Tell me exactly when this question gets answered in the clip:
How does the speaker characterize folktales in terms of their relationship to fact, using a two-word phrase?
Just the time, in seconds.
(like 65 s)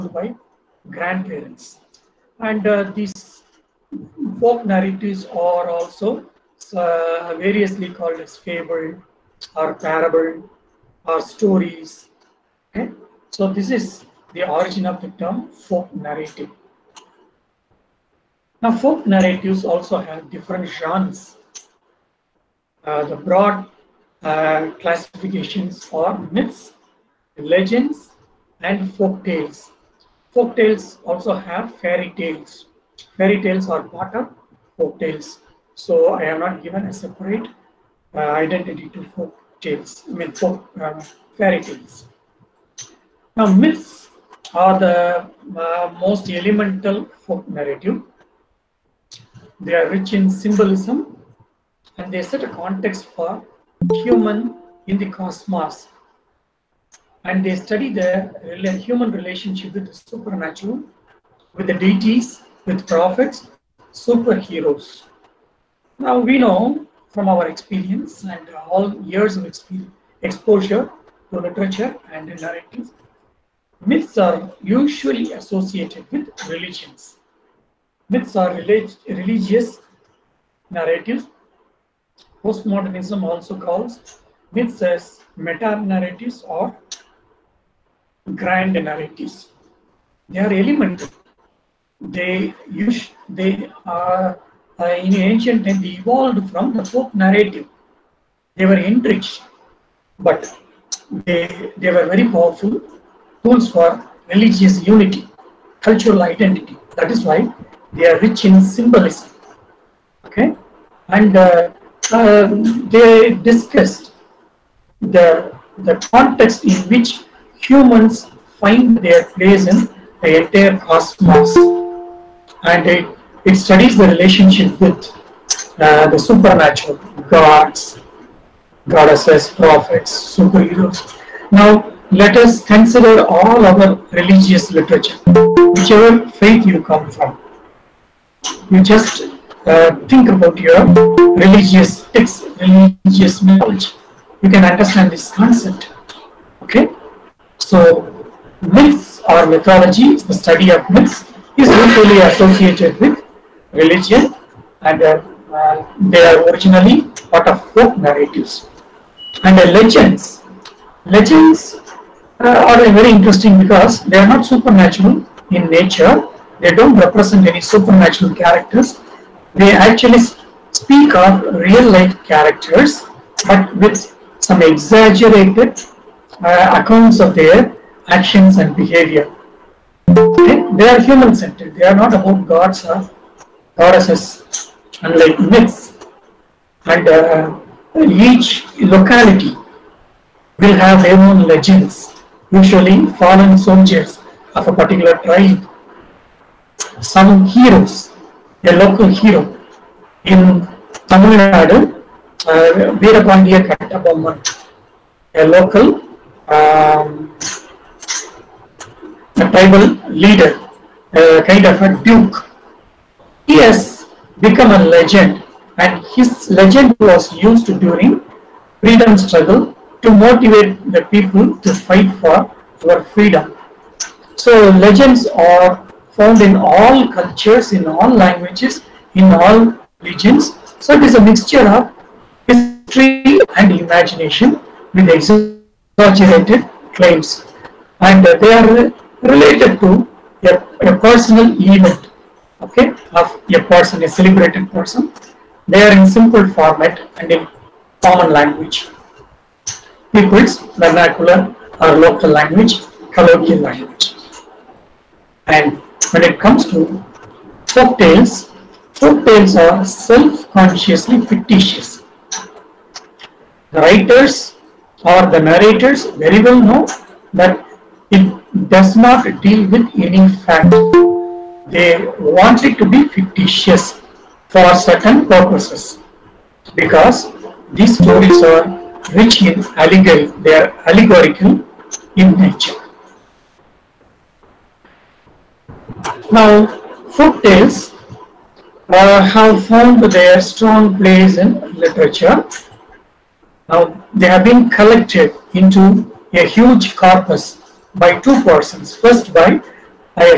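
259 s.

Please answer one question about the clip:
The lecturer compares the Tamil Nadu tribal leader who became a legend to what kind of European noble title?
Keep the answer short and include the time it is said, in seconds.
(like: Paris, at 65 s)
A duke, at 211 s.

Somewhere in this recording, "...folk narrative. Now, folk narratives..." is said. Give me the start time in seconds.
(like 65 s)
15 s.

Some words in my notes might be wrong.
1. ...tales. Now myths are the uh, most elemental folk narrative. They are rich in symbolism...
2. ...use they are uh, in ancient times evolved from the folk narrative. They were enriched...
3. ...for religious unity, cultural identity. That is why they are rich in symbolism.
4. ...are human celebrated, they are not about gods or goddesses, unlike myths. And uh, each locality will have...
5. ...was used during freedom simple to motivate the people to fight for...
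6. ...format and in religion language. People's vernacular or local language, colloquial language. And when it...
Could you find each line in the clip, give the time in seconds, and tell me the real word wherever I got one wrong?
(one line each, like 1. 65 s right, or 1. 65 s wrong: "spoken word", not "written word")
1. 41 s right
2. 92 s right
3. 103 s right
4. 180 s wrong: "centered", not "celebrated"
5. 217 s wrong: "struggle", not "simple"
6. 246 s wrong: "common", not "religion".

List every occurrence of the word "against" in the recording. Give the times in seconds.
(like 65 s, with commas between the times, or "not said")
not said.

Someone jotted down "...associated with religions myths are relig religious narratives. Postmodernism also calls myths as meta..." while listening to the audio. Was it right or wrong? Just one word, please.
right.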